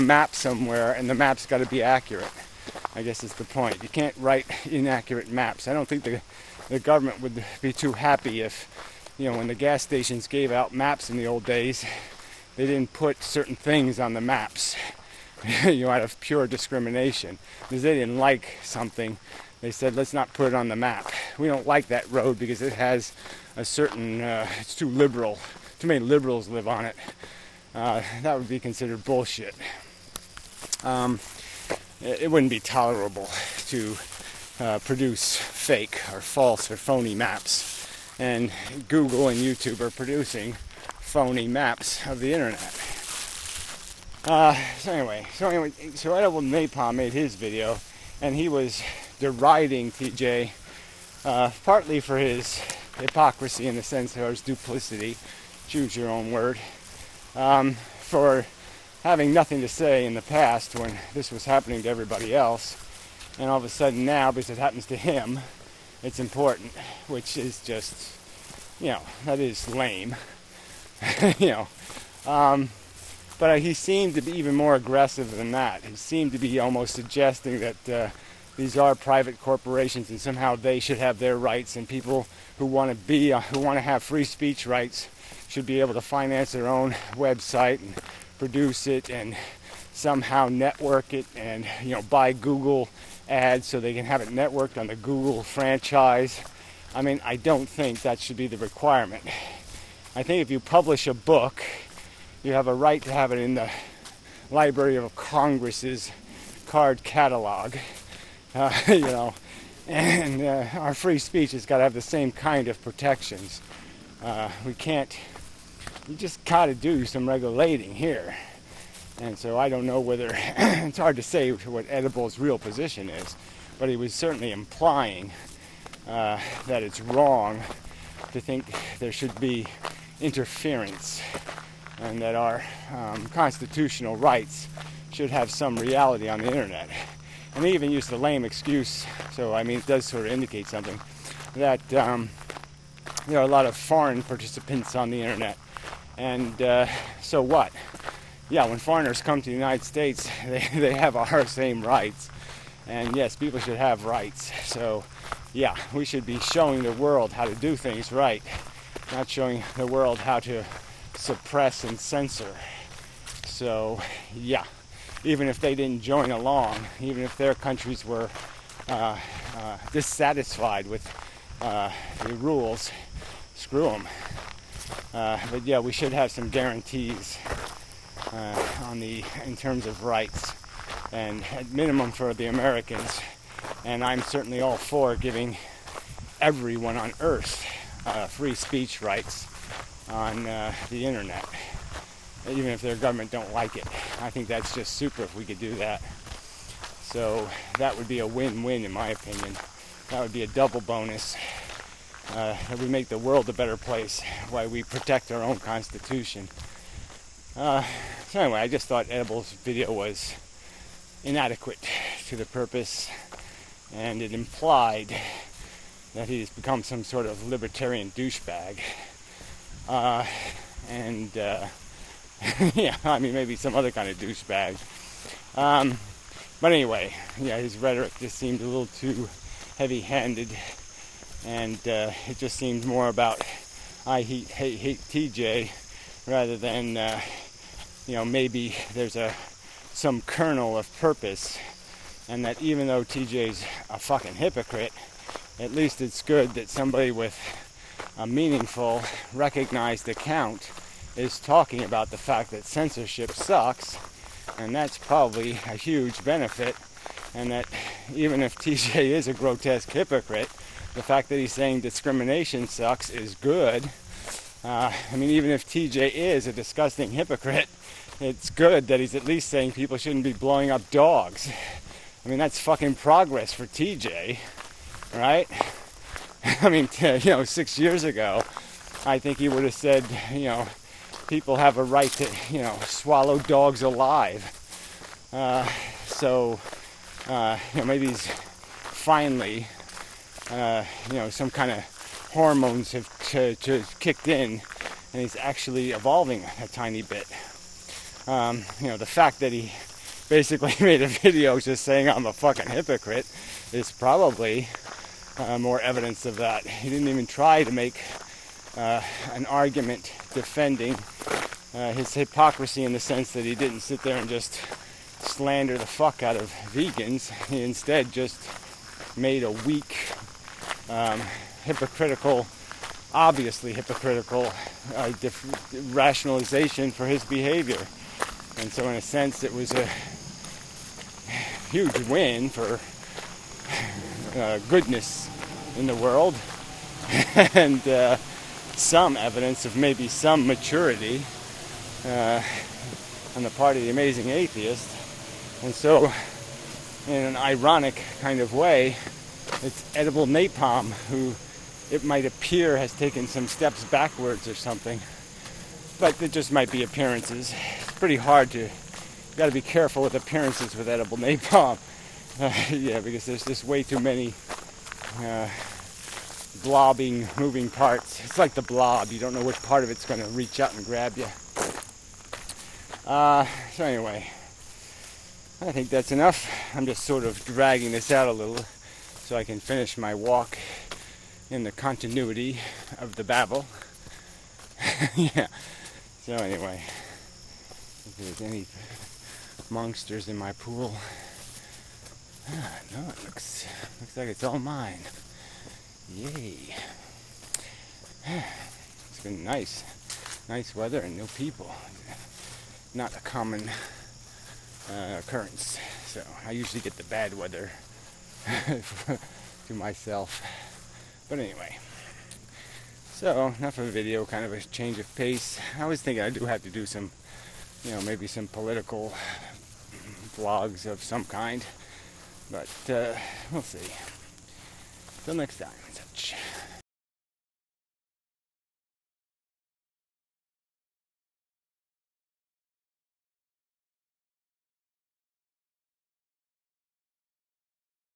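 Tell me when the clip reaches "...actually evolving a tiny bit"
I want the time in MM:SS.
04:55.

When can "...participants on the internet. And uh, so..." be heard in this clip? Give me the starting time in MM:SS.
02:24.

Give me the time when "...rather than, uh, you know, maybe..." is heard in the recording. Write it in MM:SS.
03:56.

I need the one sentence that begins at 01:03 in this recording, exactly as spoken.
And all of a sudden now, because it happens to him, it's important, which is just, you know, that is lame.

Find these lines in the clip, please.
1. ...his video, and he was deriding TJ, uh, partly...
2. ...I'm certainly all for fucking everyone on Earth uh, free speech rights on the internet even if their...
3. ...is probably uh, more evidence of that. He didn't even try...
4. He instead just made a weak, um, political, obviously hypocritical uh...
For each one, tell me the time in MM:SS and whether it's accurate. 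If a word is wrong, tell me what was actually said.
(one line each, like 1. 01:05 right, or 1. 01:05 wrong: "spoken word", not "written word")
1. 00:47 right
2. 03:04 wrong: "giving", not "fucking"
3. 05:03 right
4. 05:17 wrong: "hypocritical", not "political".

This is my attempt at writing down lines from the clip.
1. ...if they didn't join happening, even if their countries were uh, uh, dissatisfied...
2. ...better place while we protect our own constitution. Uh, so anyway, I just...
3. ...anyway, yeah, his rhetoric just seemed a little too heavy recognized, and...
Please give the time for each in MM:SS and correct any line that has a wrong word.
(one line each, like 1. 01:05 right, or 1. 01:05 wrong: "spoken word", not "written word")
1. 02:45 wrong: "along", not "happening"
2. 03:23 right
3. 03:46 wrong: "handed", not "recognized".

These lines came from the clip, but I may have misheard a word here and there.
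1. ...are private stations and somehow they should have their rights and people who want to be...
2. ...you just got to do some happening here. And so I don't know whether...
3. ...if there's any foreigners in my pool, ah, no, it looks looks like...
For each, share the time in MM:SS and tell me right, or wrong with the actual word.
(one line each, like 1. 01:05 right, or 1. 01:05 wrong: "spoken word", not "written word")
1. 01:18 wrong: "corporations", not "stations"
2. 01:56 wrong: "regulating", not "happening"
3. 06:28 wrong: "monsters", not "foreigners".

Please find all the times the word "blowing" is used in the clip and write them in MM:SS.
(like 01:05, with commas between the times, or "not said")
04:30.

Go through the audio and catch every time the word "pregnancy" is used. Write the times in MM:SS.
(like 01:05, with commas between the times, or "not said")
not said.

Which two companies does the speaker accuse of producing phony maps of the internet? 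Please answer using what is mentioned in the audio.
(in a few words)
Google and YouTube.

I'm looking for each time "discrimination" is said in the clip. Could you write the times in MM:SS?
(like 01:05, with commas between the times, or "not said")
00:16, 04:21.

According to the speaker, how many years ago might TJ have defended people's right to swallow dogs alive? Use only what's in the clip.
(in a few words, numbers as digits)
6.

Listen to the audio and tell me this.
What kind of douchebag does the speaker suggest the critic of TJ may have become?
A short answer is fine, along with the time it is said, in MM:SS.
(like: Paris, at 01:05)
libertarian, at 03:37.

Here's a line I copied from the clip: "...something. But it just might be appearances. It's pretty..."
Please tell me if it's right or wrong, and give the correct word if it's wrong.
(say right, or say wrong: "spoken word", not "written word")
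right.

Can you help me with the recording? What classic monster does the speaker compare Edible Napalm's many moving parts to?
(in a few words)
the blob.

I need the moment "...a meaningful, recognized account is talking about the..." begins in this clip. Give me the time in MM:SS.
04:08.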